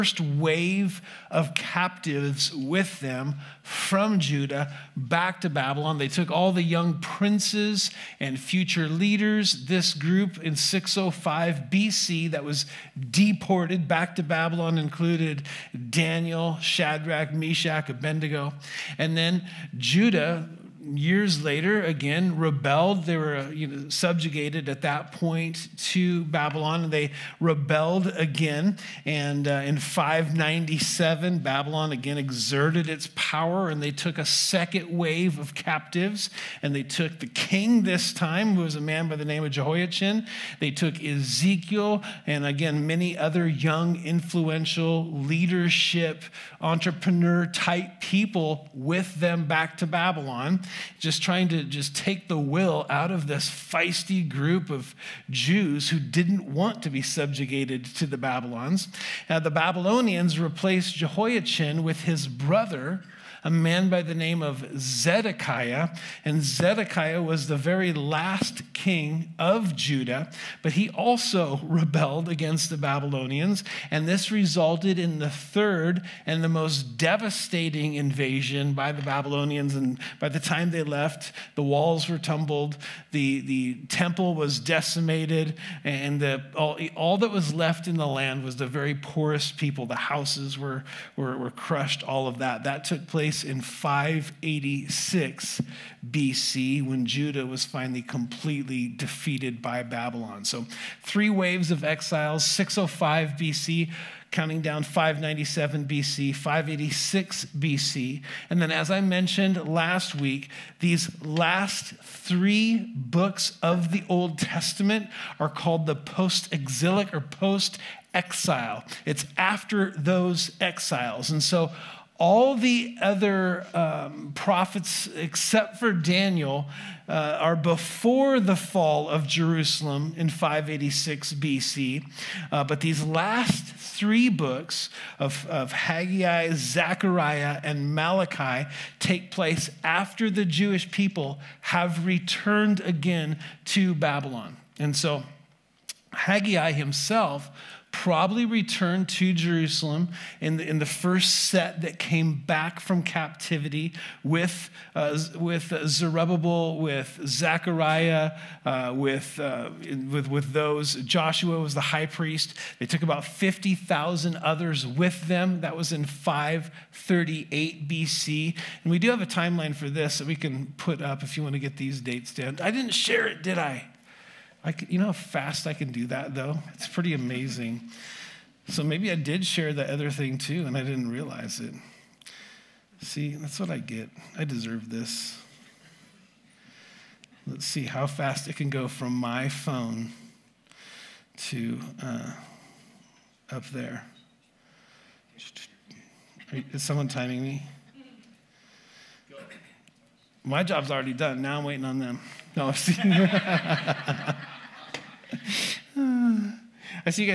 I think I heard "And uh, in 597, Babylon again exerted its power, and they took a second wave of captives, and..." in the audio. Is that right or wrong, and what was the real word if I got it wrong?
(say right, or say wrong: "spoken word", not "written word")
right.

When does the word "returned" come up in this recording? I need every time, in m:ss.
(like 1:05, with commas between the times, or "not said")
2:22, 2:28.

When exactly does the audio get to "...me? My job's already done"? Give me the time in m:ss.
3:17.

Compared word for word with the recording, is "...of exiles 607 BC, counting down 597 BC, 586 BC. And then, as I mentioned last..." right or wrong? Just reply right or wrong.
wrong.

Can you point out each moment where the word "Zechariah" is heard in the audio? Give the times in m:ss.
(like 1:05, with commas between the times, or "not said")
2:16, 2:37.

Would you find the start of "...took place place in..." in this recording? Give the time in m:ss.
1:32.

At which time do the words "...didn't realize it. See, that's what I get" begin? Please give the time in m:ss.
3:00.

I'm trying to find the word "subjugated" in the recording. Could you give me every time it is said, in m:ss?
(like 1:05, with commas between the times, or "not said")
0:23, 0:57.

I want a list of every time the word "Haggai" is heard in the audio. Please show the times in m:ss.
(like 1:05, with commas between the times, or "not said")
2:15, 2:26.